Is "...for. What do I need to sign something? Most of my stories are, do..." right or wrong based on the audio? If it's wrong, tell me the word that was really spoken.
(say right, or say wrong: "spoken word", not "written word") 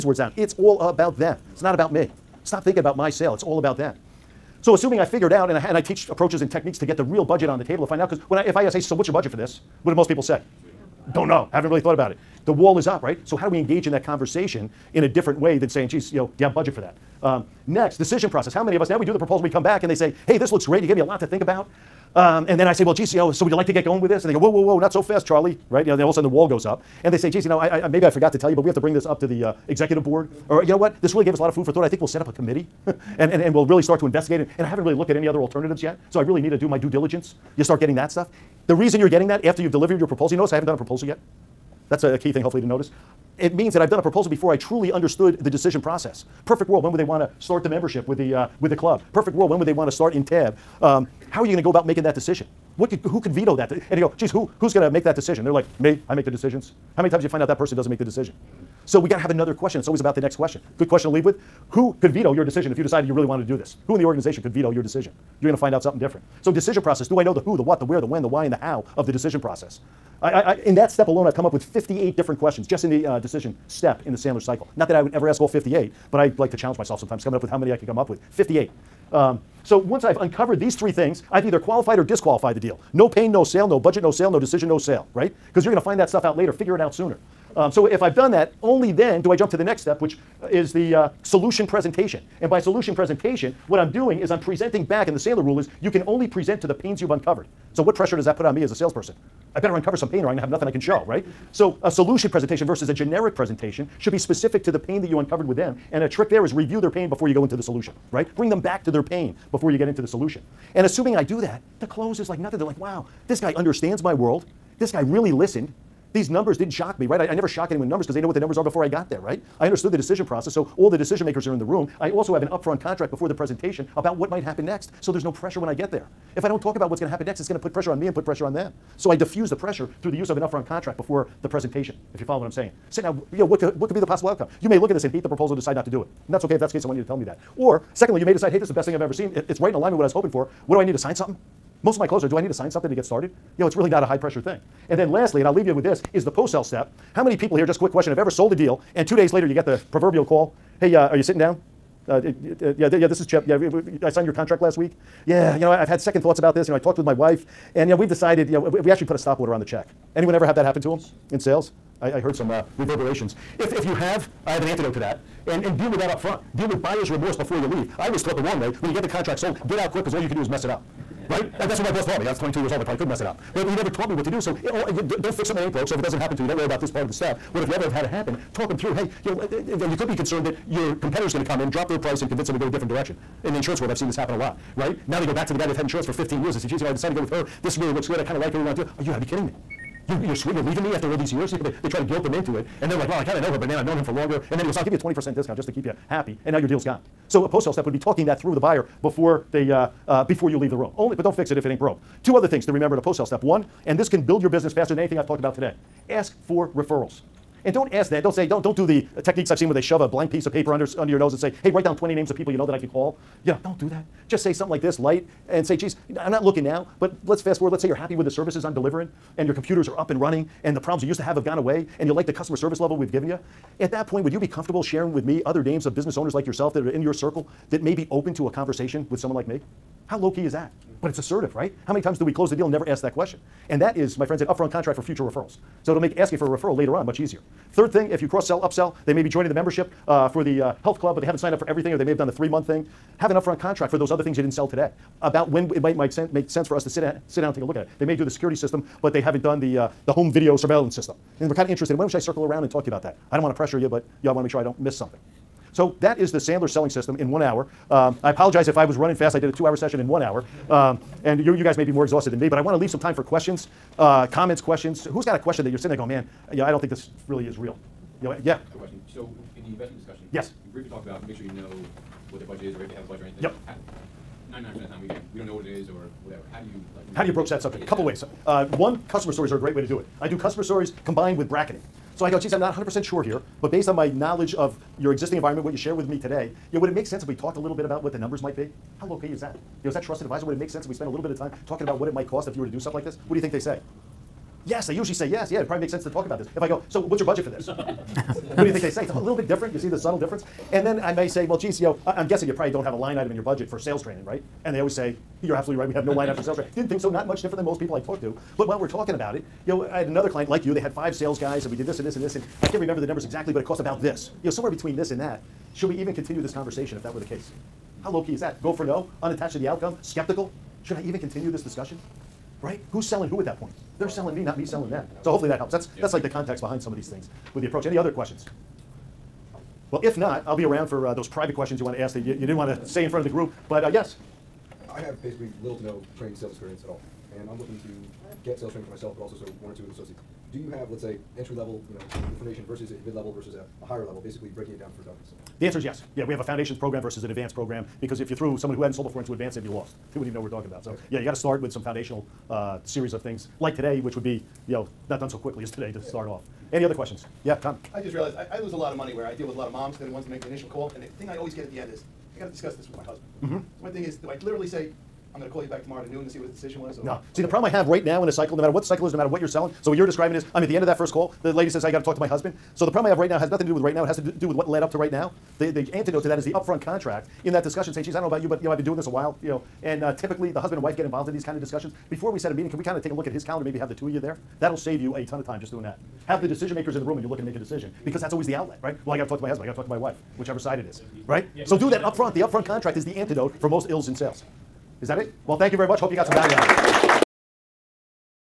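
wrong: "clothes", not "stories".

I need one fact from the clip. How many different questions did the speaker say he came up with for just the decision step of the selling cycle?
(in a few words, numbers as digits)
58.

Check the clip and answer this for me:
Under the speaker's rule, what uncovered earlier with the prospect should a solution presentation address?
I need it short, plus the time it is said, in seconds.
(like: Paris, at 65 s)
The pains, at 96 s.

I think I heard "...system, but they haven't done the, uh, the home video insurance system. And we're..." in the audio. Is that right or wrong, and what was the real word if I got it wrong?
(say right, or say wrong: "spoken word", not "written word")
wrong: "surveillance", not "insurance".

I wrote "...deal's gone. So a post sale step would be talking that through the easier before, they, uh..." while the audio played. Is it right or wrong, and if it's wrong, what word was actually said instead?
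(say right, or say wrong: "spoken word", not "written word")
wrong: "buyer", not "easier".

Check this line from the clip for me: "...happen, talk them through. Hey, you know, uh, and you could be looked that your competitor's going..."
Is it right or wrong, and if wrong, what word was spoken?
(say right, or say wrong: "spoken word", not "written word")
wrong: "concerned", not "looked".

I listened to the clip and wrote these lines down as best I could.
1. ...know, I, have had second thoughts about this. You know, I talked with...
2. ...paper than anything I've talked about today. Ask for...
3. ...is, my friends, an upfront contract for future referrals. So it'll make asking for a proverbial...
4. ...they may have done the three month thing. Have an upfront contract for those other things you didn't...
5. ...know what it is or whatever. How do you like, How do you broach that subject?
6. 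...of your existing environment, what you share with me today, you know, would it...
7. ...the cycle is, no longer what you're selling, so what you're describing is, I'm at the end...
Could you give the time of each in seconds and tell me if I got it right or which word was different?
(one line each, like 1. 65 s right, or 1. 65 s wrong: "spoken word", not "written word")
1. 155 s right
2. 204 s wrong: "faster", not "paper"
3. 233 s wrong: "referral", not "proverbial"
4. 241 s right
5. 275 s right
6. 284 s right
7. 368 s wrong: "matter", not "longer".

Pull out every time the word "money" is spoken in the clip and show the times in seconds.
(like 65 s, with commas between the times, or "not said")
358 s.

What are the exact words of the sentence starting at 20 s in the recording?
You gave me a lot to think about.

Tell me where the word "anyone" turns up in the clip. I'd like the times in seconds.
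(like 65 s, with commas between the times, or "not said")
117 s, 160 s.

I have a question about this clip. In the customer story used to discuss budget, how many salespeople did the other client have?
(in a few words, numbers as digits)
5.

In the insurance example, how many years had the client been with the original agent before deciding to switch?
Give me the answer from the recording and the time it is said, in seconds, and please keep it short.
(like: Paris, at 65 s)
15 years, at 186 s.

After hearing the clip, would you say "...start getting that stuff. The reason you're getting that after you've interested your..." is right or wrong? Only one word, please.
wrong.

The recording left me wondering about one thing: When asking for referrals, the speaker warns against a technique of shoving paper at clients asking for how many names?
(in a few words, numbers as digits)
20.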